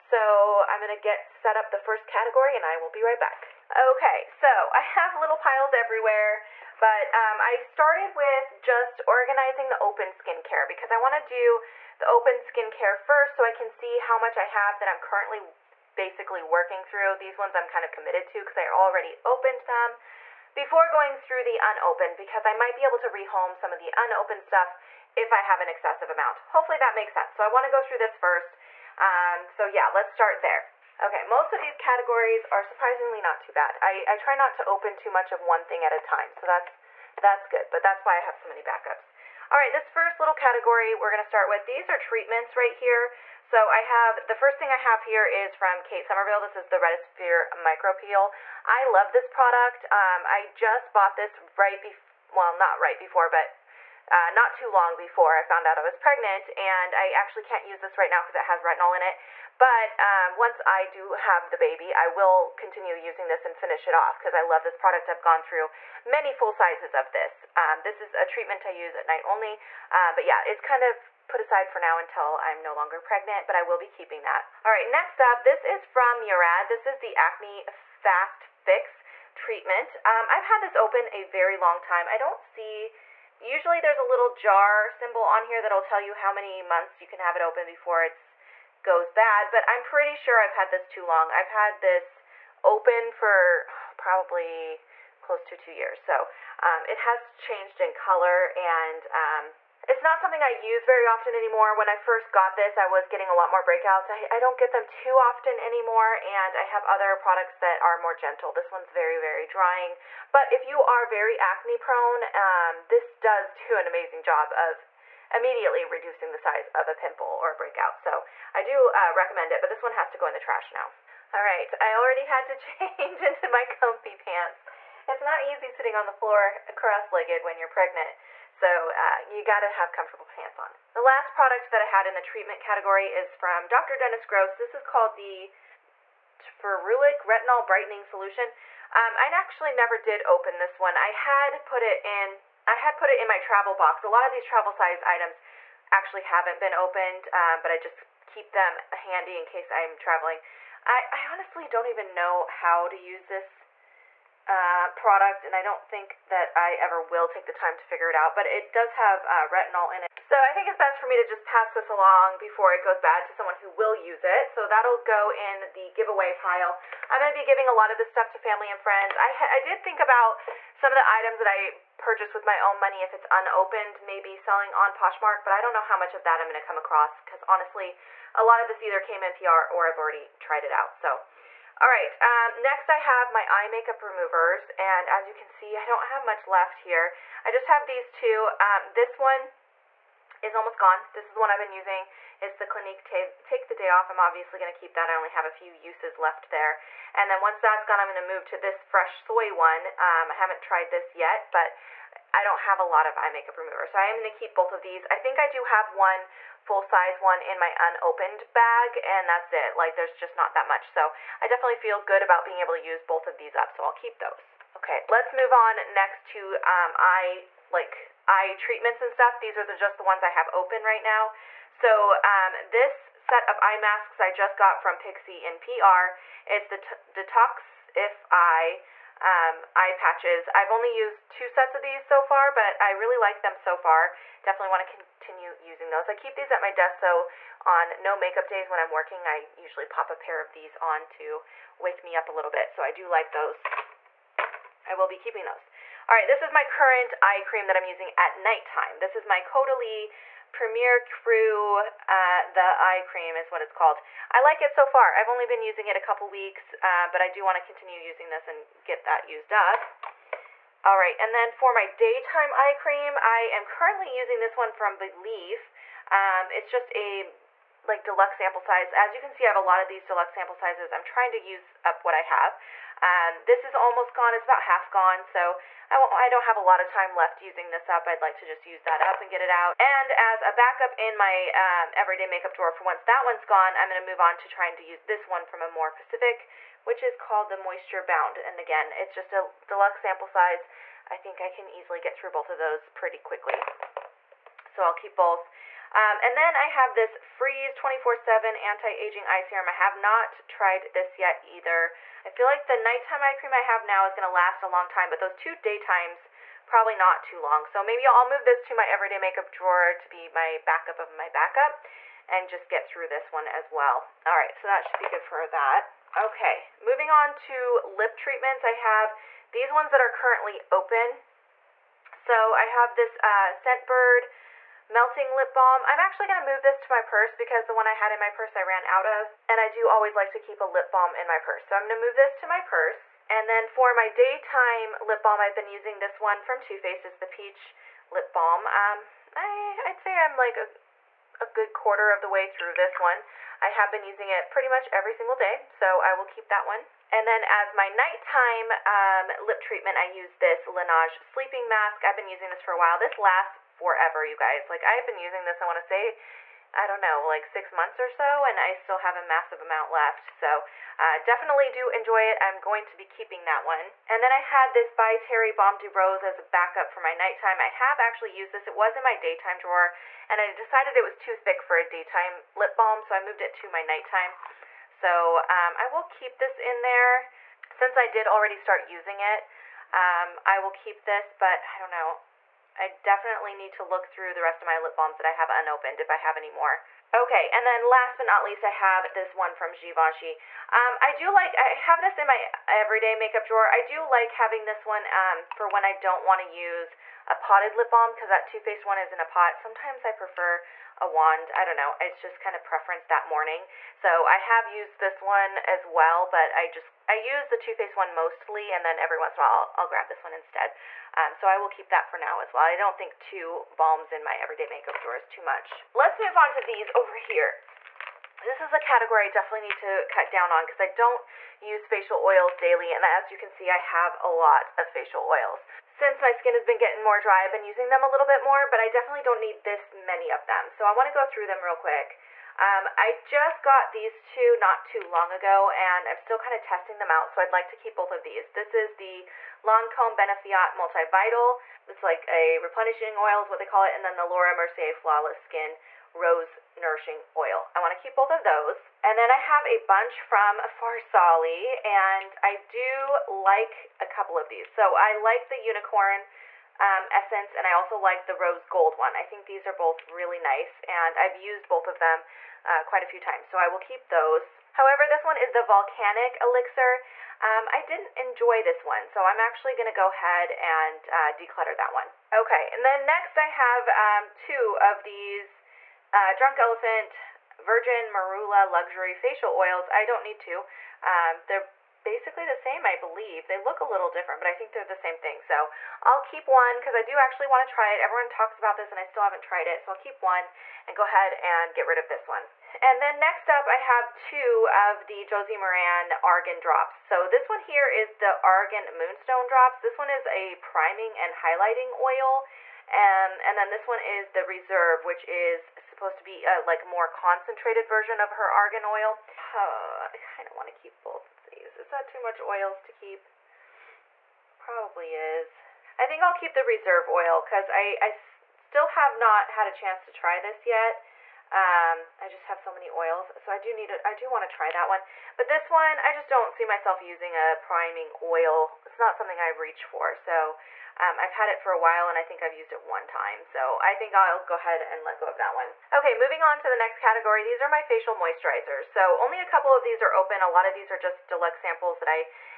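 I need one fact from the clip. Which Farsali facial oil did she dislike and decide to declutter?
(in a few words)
Volcanic Elixir.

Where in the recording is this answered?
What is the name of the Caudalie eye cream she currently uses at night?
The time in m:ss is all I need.
4:10.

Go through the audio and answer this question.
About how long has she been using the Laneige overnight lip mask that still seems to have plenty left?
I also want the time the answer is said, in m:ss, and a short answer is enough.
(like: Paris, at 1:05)
6 months, at 5:57.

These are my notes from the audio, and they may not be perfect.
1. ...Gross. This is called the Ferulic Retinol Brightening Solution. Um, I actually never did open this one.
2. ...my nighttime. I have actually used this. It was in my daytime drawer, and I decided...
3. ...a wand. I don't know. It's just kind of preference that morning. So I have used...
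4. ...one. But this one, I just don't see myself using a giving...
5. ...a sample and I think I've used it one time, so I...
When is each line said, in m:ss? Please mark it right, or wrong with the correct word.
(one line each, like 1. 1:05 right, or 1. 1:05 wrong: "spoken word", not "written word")
1. 2:14 right
2. 6:06 right
3. 6:40 right
4. 8:44 wrong: "priming", not "giving"
5. 8:51 wrong: "while", not "sample".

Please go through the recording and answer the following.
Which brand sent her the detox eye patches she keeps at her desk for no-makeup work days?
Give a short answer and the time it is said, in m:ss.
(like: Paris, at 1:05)
Pixi, at 3:44.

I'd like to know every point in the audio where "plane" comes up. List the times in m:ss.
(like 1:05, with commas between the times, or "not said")
not said.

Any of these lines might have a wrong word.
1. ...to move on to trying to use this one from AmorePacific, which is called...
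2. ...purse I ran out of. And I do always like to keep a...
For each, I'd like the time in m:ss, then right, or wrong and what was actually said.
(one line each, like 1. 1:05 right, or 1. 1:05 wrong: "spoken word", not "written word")
1. 4:43 right
2. 5:28 right.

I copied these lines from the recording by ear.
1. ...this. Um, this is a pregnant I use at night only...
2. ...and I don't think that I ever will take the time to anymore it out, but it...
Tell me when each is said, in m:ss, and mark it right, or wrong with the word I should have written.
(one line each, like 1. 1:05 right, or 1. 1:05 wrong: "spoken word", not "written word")
1. 1:07 wrong: "treatment", not "pregnant"
2. 2:35 wrong: "figure", not "anymore".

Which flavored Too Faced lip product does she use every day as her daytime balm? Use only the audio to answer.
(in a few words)
Peach Lip Balm.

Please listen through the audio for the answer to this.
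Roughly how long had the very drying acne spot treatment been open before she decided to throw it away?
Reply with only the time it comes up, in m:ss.
1:35.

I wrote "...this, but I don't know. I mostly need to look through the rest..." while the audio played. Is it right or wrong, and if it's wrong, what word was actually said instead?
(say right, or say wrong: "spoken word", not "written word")
wrong: "definitely", not "mostly".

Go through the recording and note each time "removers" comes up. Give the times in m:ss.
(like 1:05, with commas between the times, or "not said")
3:04, 3:23.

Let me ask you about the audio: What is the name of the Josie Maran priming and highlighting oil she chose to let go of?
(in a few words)
Argan Moonstone drops.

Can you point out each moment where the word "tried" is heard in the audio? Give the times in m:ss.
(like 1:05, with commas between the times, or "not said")
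3:00, 3:20, 5:00, 8:09.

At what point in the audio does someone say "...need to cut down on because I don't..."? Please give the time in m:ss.
6:59.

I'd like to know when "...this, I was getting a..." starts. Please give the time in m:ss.
1:42.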